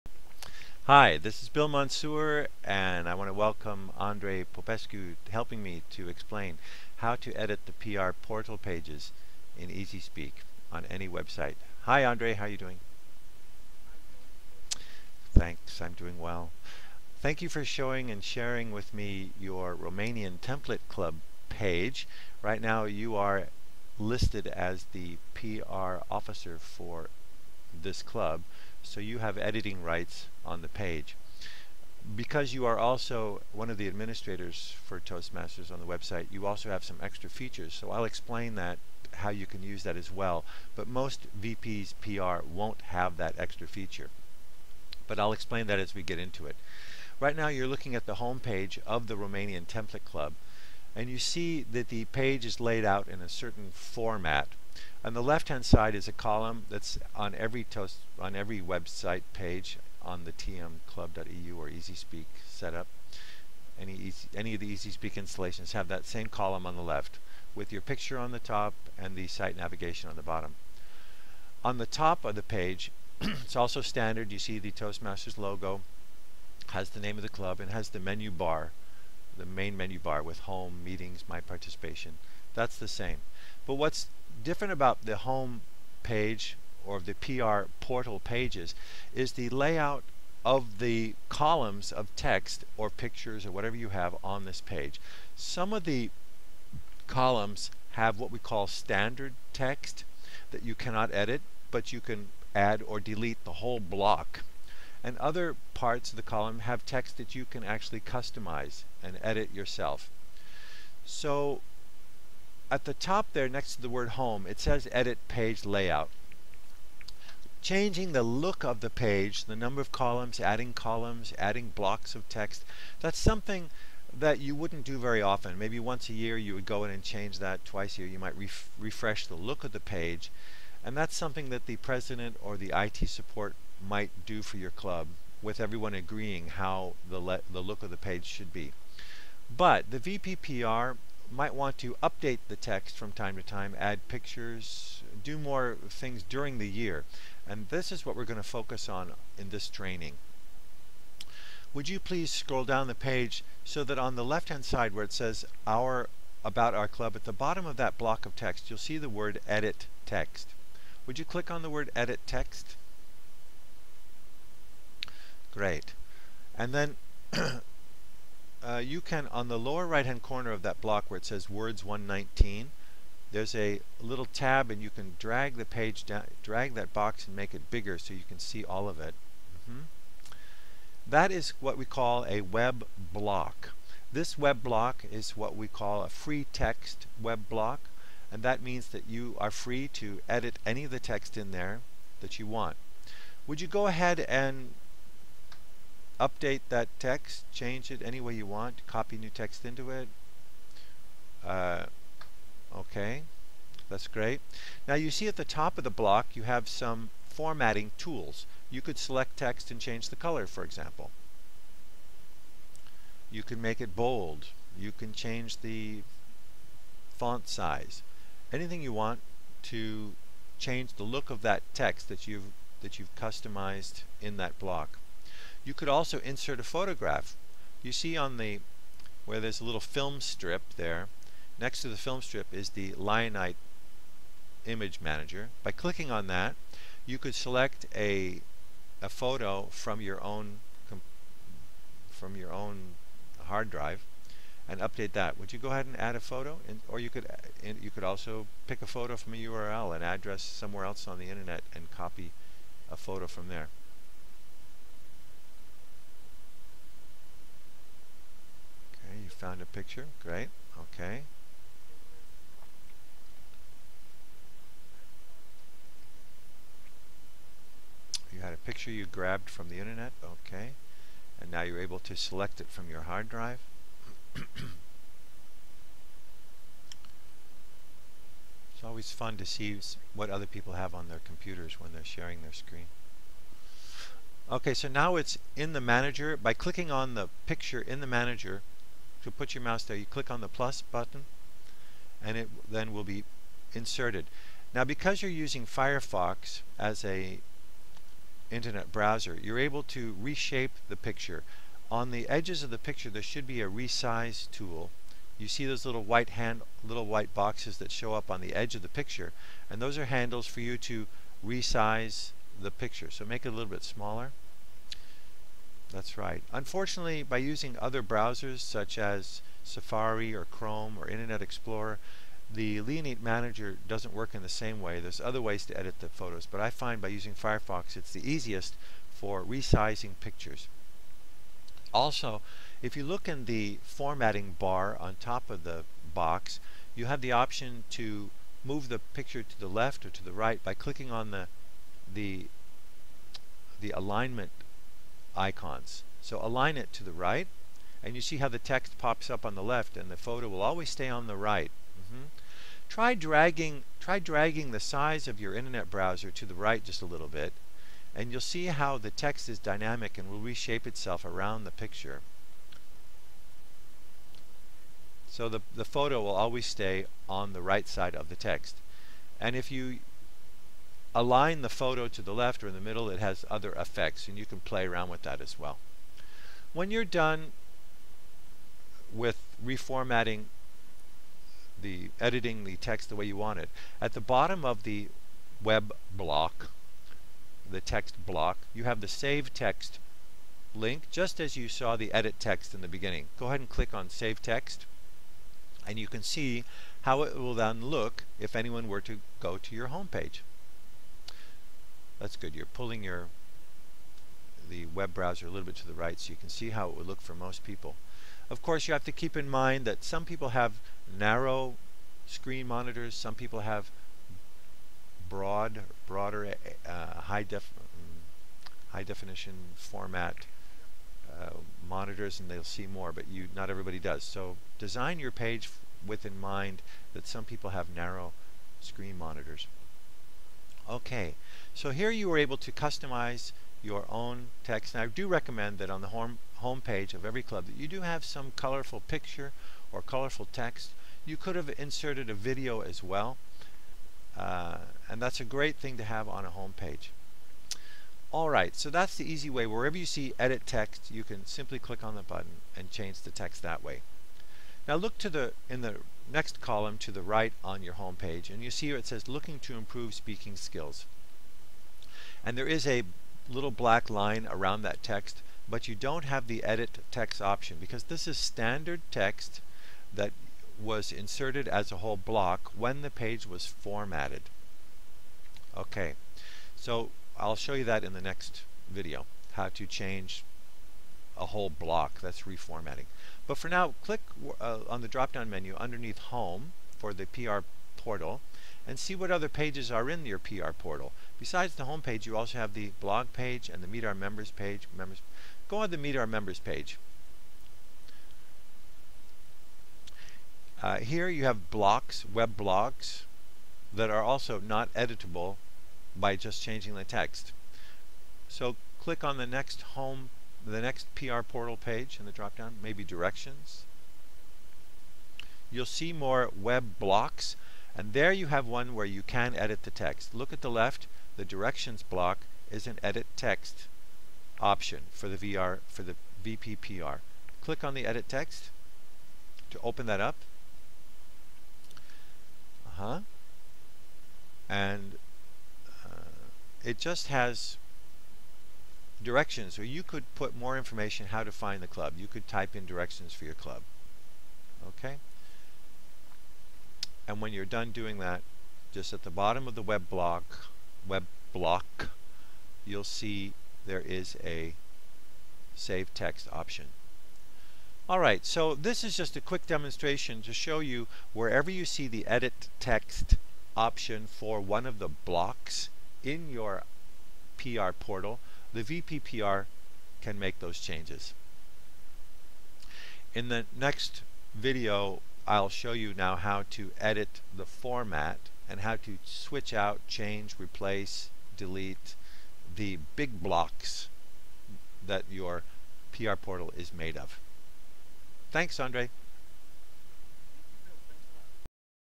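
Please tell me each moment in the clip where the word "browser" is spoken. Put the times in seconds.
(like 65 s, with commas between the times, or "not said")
298 s, 318 s, 355 s, 405 s.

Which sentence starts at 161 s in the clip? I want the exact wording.
Would you click on the word edit text?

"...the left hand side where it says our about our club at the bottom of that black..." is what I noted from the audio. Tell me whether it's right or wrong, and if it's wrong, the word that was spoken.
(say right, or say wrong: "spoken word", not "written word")
wrong: "block", not "black".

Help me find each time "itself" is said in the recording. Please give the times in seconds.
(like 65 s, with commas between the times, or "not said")
360 s.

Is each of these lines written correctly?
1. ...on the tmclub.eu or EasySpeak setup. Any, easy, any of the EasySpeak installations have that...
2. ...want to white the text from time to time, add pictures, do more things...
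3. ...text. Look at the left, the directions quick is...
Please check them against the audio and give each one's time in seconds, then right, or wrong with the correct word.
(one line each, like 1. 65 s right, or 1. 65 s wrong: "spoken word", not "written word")
1. 60 s right
2. 141 s wrong: "update", not "white"
3. 519 s wrong: "block", not "quick".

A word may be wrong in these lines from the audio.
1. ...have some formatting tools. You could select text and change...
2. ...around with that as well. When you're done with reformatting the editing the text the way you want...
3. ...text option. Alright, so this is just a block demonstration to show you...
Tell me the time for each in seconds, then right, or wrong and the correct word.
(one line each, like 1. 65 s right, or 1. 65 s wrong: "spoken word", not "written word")
1. 206 s right
2. 374 s right
3. 556 s wrong: "quick", not "block".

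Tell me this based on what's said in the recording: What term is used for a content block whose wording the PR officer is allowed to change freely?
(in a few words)
free text web block.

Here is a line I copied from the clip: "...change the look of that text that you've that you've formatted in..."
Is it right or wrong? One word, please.
wrong.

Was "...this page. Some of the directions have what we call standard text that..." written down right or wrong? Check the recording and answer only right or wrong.
wrong.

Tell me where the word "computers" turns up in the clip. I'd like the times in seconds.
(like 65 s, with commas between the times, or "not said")
281 s.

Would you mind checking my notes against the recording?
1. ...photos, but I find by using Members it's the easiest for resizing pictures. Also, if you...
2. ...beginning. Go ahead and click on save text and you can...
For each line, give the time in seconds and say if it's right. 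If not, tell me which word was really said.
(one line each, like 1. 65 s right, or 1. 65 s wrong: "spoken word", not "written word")
1. 326 s wrong: "Firefox", not "Members"
2. 392 s right.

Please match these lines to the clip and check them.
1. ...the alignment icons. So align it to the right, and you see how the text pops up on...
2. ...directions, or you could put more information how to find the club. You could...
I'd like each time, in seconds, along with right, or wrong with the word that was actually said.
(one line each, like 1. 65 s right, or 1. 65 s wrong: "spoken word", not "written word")
1. 343 s right
2. 539 s right.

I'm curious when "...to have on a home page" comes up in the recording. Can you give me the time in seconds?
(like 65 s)
445 s.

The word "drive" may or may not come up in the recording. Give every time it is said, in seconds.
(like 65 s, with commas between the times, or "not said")
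243 s, 273 s.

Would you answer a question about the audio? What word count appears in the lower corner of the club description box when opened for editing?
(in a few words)
119.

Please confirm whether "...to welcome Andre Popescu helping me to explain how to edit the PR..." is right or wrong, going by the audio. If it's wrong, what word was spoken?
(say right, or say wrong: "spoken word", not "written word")
right.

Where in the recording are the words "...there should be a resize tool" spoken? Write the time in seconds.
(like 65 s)
303 s.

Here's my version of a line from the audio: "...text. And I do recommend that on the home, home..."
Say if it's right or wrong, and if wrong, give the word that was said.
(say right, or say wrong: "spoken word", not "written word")
right.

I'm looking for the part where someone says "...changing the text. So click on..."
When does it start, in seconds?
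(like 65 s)
506 s.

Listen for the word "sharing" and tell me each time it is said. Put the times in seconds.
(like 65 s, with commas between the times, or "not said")
18 s, 282 s.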